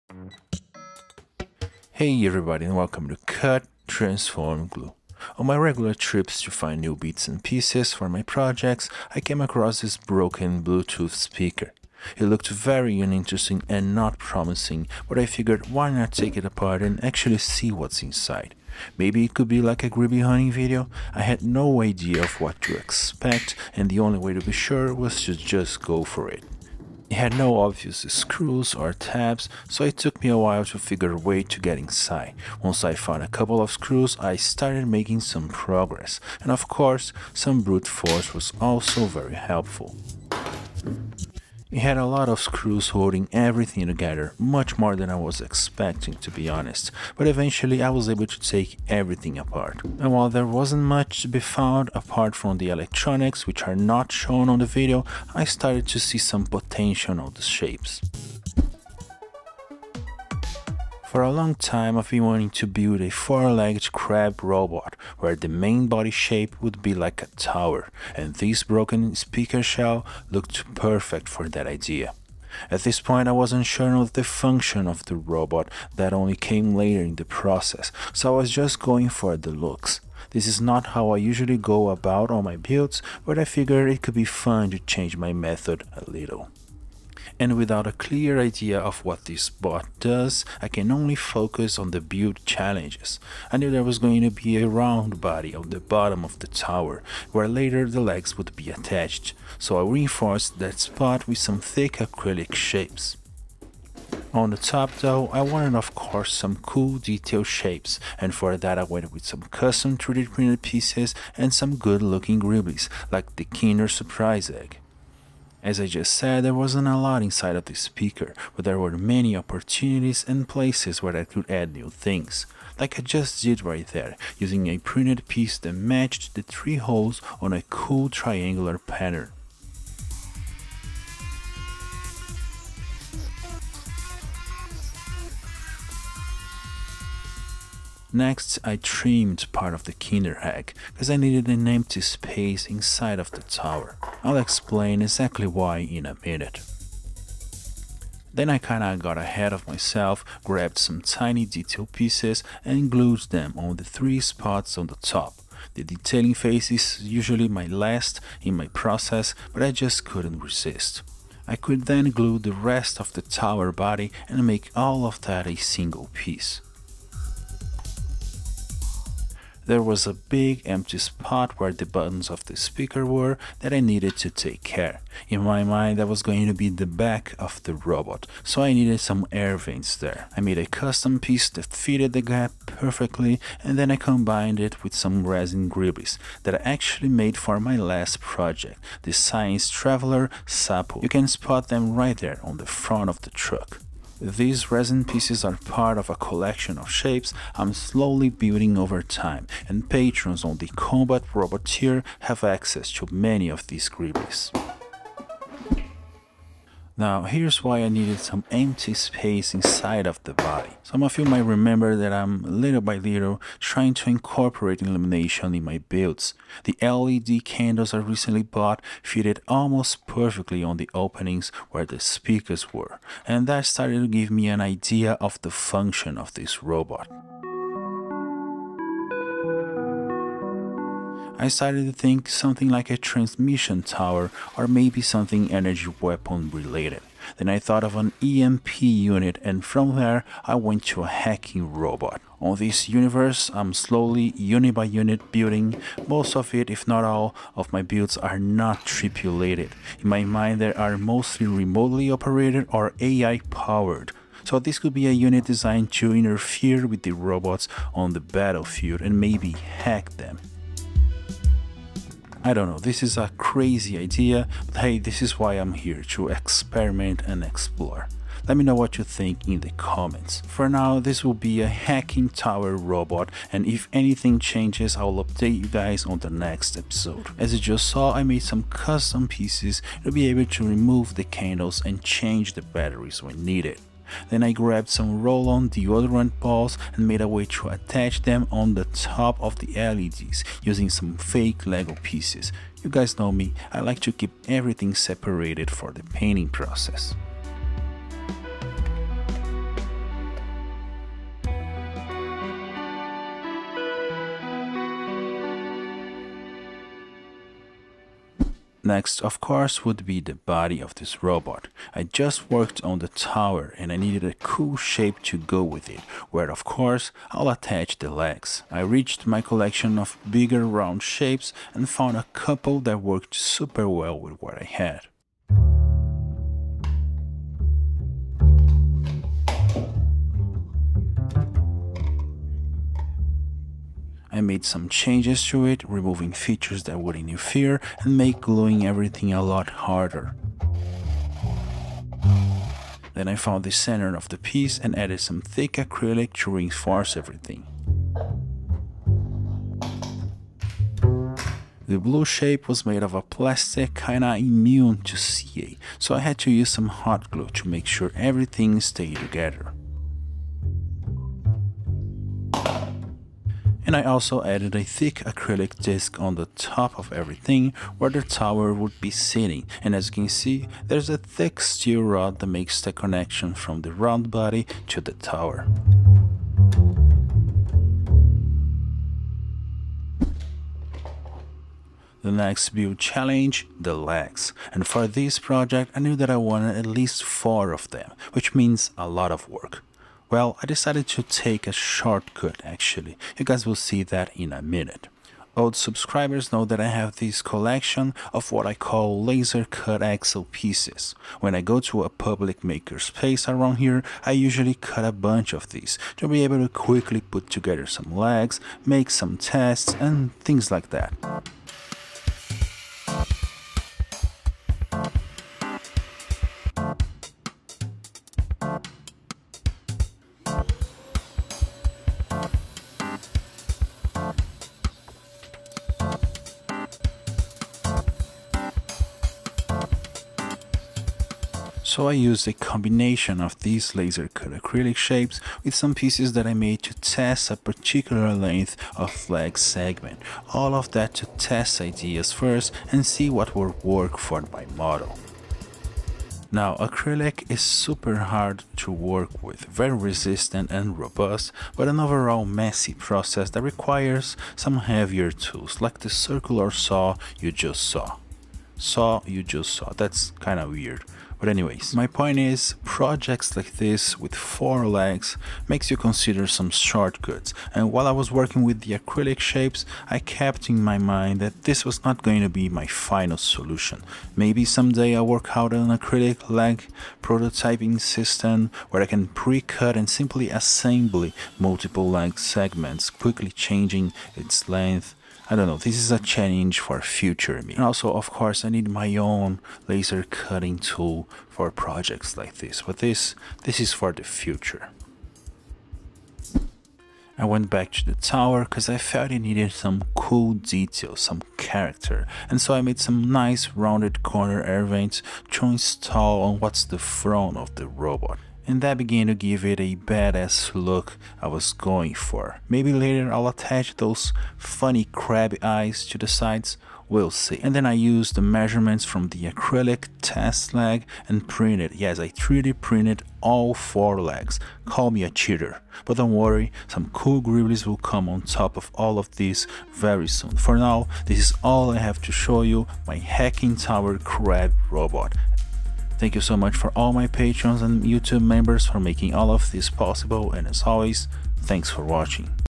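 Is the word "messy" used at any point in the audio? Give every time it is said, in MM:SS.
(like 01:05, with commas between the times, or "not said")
07:32.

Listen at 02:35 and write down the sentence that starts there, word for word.
The detailing phase is usually my last in my process, but I just couldn't resist.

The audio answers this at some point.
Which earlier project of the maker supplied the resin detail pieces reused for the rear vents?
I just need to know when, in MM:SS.
03:09.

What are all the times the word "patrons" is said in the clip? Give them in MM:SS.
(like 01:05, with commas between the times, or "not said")
03:19, 08:57.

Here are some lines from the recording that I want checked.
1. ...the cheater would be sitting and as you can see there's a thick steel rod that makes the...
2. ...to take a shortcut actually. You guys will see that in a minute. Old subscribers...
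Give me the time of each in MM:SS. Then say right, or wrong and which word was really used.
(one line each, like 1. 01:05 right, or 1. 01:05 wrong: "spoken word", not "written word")
1. 06:08 wrong: "tower", not "cheater"
2. 06:31 right.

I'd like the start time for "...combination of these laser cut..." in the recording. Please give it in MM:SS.
07:12.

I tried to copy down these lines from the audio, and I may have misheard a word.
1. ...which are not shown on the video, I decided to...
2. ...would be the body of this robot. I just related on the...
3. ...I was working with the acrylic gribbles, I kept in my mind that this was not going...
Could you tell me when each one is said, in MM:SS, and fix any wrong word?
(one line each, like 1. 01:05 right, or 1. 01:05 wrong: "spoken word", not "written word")
1. 00:53 wrong: "started", not "decided"
2. 05:09 wrong: "worked", not "related"
3. 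07:48 wrong: "shapes", not "gribbles".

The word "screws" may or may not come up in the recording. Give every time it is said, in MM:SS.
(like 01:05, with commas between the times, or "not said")
00:28, 00:33, 00:42.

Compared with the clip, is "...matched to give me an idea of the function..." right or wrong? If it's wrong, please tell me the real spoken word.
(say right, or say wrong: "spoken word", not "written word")
wrong: "started", not "matched".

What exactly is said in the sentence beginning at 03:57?
Then I thought of an EMP unit and from there I went to a hacking robot.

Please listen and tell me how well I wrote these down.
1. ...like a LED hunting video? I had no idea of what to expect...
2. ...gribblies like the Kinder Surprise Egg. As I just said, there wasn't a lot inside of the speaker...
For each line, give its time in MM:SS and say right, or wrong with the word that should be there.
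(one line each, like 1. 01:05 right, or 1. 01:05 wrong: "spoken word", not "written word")
1. 00:19 wrong: "Gribby", not "LED"
2. 01:52 right.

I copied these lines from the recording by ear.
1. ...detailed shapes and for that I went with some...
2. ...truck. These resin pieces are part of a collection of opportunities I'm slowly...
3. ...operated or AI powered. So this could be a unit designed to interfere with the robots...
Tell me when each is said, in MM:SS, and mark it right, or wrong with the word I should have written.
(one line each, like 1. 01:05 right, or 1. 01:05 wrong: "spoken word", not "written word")
1. 01:46 right
2. 03:13 wrong: "shapes", not "opportunities"
3. 04:12 right.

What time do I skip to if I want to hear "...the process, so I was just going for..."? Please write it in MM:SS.
01:17.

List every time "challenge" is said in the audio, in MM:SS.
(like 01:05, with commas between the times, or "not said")
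01:32, 06:22, 08:06.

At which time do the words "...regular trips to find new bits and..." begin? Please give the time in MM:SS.
00:05.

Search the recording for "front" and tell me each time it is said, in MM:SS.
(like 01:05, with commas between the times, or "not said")
03:12, 08:26.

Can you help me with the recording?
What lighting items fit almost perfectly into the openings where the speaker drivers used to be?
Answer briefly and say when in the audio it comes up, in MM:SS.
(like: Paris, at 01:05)
LED candles, at 03:36.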